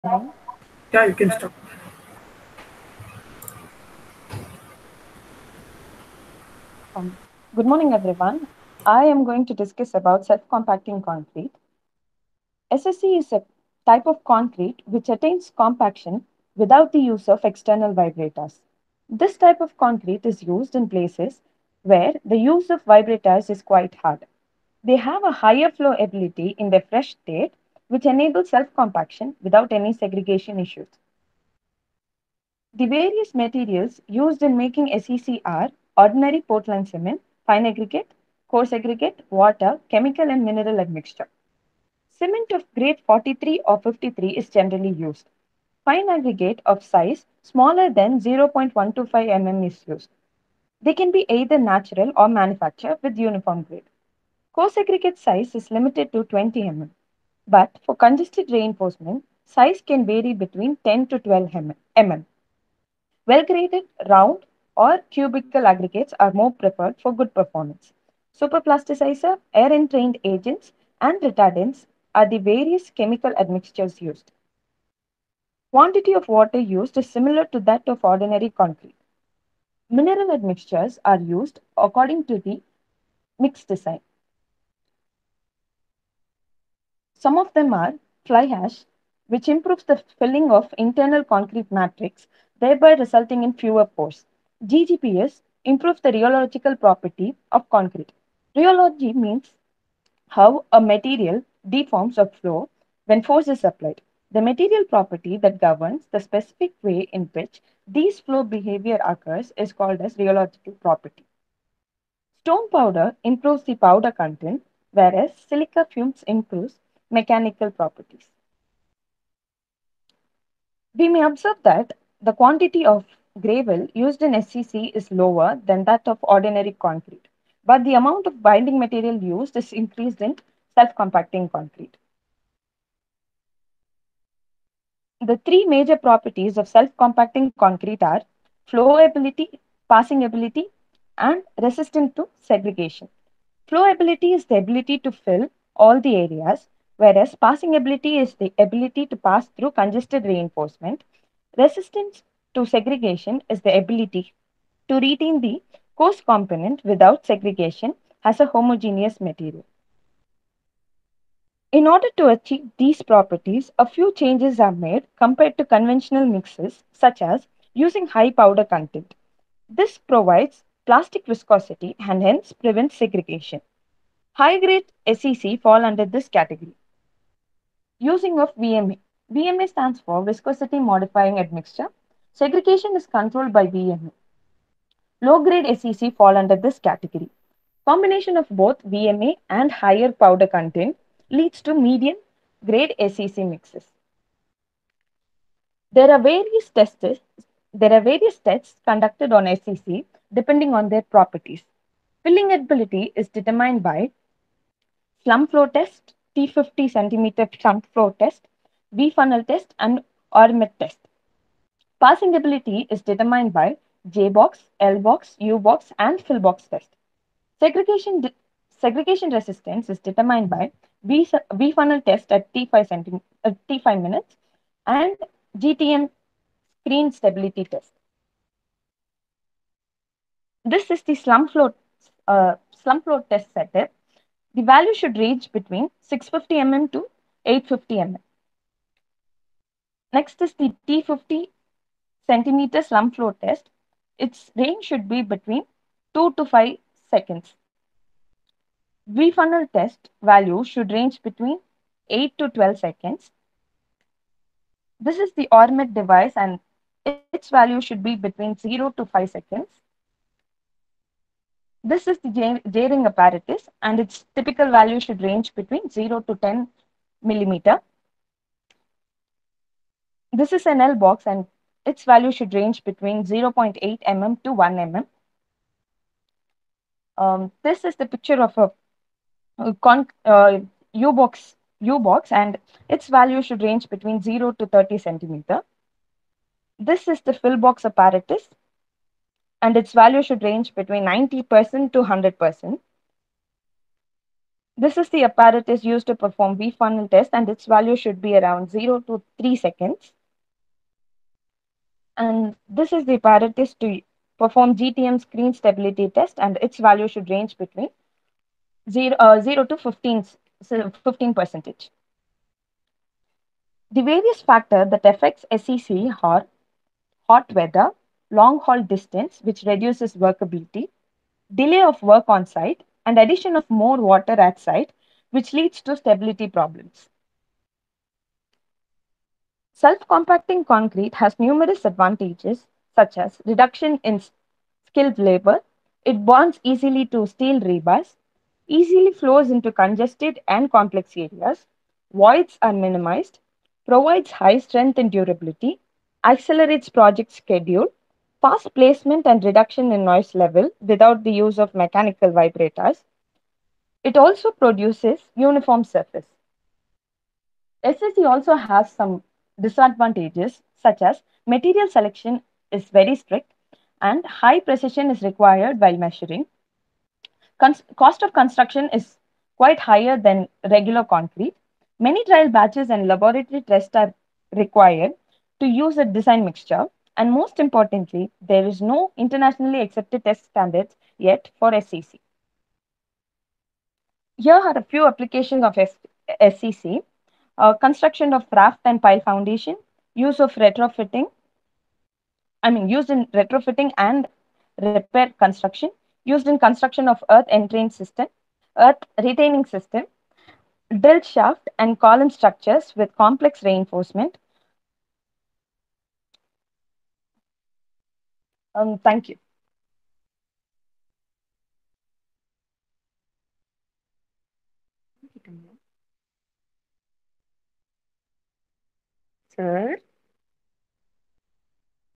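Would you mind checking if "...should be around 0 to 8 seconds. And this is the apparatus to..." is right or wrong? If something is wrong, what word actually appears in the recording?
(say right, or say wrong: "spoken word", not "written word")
wrong: "3", not "8".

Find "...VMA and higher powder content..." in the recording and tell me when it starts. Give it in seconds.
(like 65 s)
188 s.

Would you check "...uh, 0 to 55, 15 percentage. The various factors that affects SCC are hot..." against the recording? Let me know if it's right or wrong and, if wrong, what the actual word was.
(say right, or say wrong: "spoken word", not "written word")
wrong: "15", not "55".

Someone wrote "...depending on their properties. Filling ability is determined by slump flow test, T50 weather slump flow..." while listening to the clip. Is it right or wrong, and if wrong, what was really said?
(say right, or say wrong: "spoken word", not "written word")
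wrong: "centimeter", not "weather".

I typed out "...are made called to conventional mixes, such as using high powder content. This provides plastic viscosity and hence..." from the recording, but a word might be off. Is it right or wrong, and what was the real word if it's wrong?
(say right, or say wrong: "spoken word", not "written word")
wrong: "compared", not "called".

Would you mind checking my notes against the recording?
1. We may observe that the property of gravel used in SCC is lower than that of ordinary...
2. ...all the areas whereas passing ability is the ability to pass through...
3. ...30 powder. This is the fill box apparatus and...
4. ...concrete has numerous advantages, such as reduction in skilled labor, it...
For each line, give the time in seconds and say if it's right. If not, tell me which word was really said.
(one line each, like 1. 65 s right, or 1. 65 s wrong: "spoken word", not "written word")
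1. 120 s wrong: "quantity", not "property"
2. 145 s right
3. 284 s wrong: "centimeter", not "powder"
4. 330 s right.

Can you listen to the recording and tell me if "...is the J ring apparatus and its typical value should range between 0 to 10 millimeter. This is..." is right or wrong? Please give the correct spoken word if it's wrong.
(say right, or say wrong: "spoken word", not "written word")
right.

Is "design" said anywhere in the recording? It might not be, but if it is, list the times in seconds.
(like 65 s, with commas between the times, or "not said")
83 s, 376 s.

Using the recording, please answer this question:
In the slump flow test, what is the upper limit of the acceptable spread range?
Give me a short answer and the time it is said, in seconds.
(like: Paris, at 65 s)
850 mm, at 237 s.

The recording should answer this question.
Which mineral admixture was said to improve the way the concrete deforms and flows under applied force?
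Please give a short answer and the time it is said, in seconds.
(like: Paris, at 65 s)
GGBS, at 94 s.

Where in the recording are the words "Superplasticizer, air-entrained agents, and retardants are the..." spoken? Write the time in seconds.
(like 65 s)
68 s.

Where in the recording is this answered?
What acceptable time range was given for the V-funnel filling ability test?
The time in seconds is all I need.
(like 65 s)
252 s.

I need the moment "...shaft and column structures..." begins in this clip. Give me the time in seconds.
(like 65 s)
401 s.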